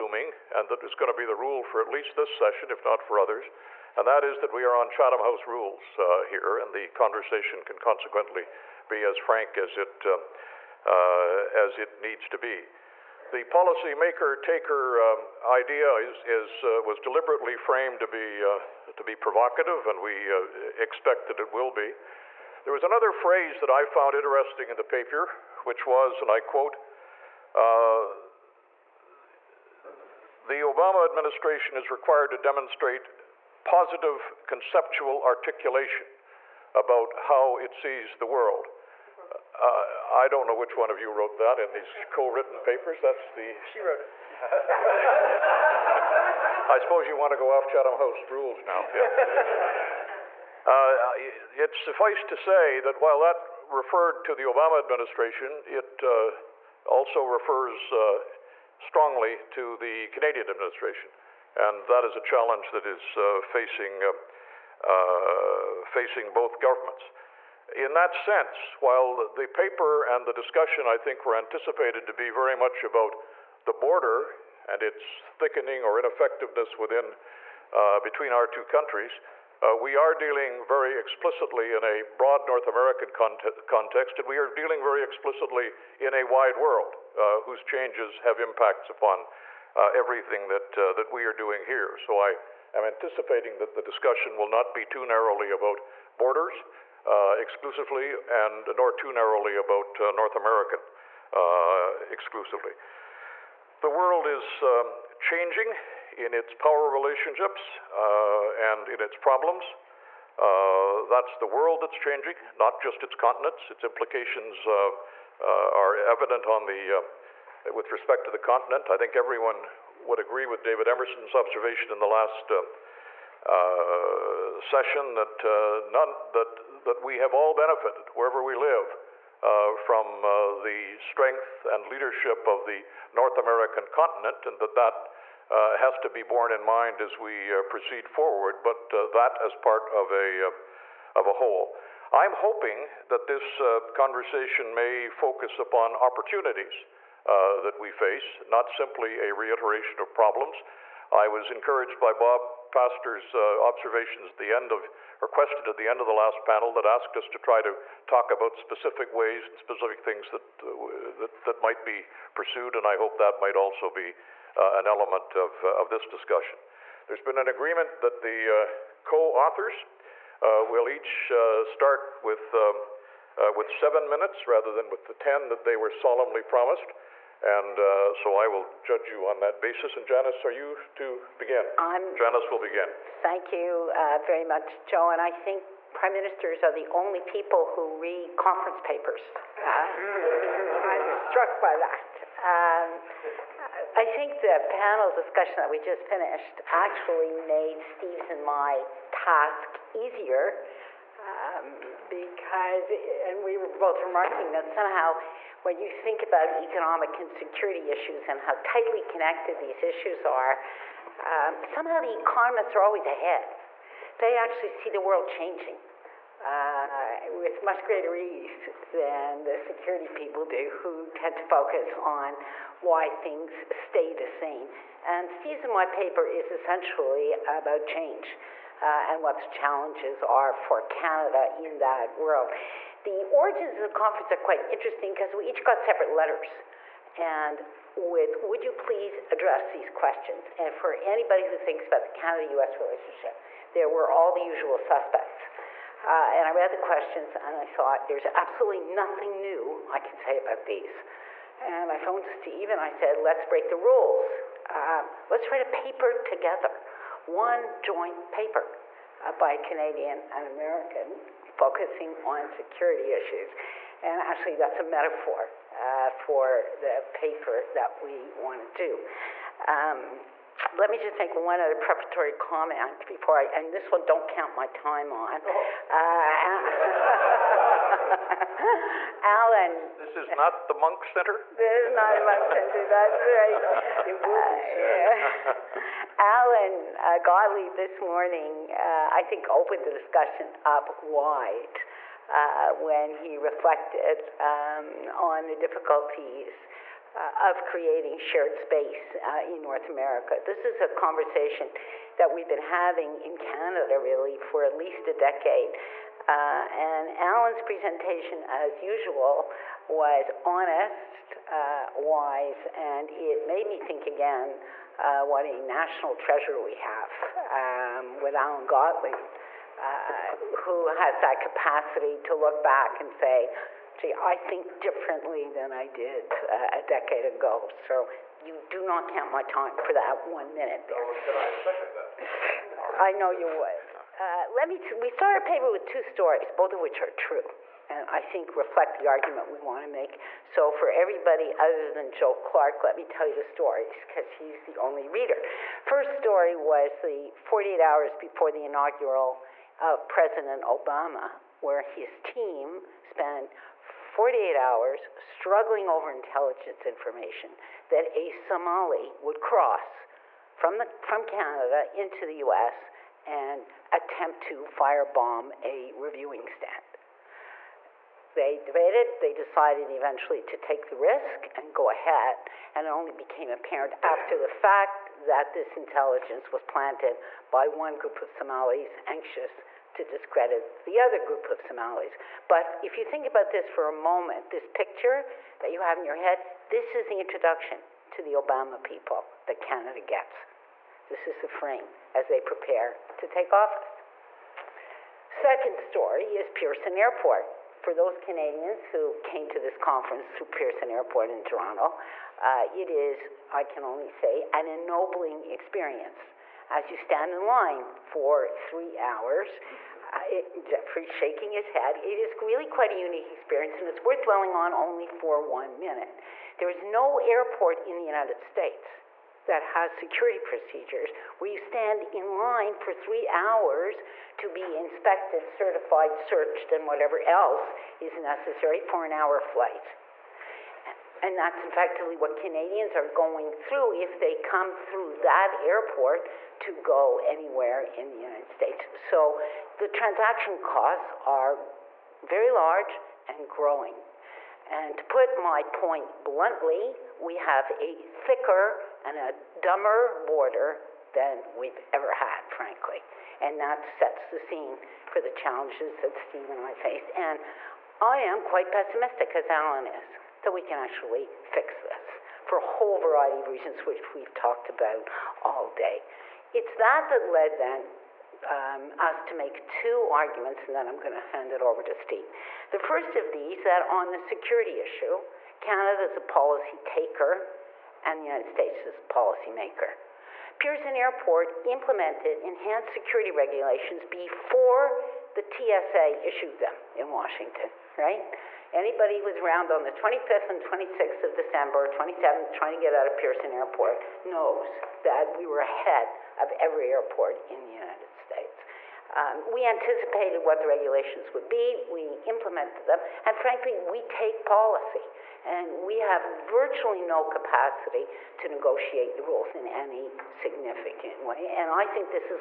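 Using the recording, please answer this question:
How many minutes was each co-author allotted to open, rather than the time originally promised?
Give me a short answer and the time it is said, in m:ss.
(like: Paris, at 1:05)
7, at 2:53.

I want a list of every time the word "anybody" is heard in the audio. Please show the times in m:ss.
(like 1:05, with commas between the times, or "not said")
4:00, 8:08.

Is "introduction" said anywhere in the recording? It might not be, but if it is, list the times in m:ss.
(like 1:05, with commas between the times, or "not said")
6:27.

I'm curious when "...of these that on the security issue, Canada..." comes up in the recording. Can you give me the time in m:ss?
7:53.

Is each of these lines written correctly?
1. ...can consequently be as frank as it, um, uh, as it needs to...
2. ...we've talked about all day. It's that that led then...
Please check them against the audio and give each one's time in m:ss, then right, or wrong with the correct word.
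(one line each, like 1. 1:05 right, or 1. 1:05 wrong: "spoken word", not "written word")
1. 0:07 right
2. 7:44 right.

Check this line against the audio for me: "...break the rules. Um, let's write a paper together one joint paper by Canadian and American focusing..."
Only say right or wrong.
right.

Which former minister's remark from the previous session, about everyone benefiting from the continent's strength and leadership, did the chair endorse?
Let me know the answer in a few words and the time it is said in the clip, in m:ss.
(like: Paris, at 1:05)
David Emerson, at 2:00.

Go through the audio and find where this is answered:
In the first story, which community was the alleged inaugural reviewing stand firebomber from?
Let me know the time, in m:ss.
5:58.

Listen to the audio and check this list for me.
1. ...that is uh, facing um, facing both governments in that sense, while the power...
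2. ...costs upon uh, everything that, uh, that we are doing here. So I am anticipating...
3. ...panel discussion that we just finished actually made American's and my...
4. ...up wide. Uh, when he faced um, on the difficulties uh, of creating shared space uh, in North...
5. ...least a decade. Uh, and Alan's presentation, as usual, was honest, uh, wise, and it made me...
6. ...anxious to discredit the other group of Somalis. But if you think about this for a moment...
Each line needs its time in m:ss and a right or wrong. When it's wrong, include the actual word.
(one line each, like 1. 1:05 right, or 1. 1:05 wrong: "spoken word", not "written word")
1. 1:02 wrong: "paper", not "power"
2. 1:28 wrong: "impacts", not "costs"
3. 3:14 wrong: "Steve", not "American"
4. 4:50 wrong: "reflected", not "faced"
5. 5:04 right
6. 6:19 right.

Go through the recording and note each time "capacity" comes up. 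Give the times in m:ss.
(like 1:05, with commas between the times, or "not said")
5:21, 8:27.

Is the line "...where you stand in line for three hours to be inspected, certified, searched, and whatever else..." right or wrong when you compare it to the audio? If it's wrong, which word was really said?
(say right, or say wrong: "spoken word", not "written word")
right.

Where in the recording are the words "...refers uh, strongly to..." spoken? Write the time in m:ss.
0:57.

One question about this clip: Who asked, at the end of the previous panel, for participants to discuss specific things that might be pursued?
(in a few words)
Bob Pastor.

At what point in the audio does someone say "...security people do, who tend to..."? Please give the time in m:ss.
3:39.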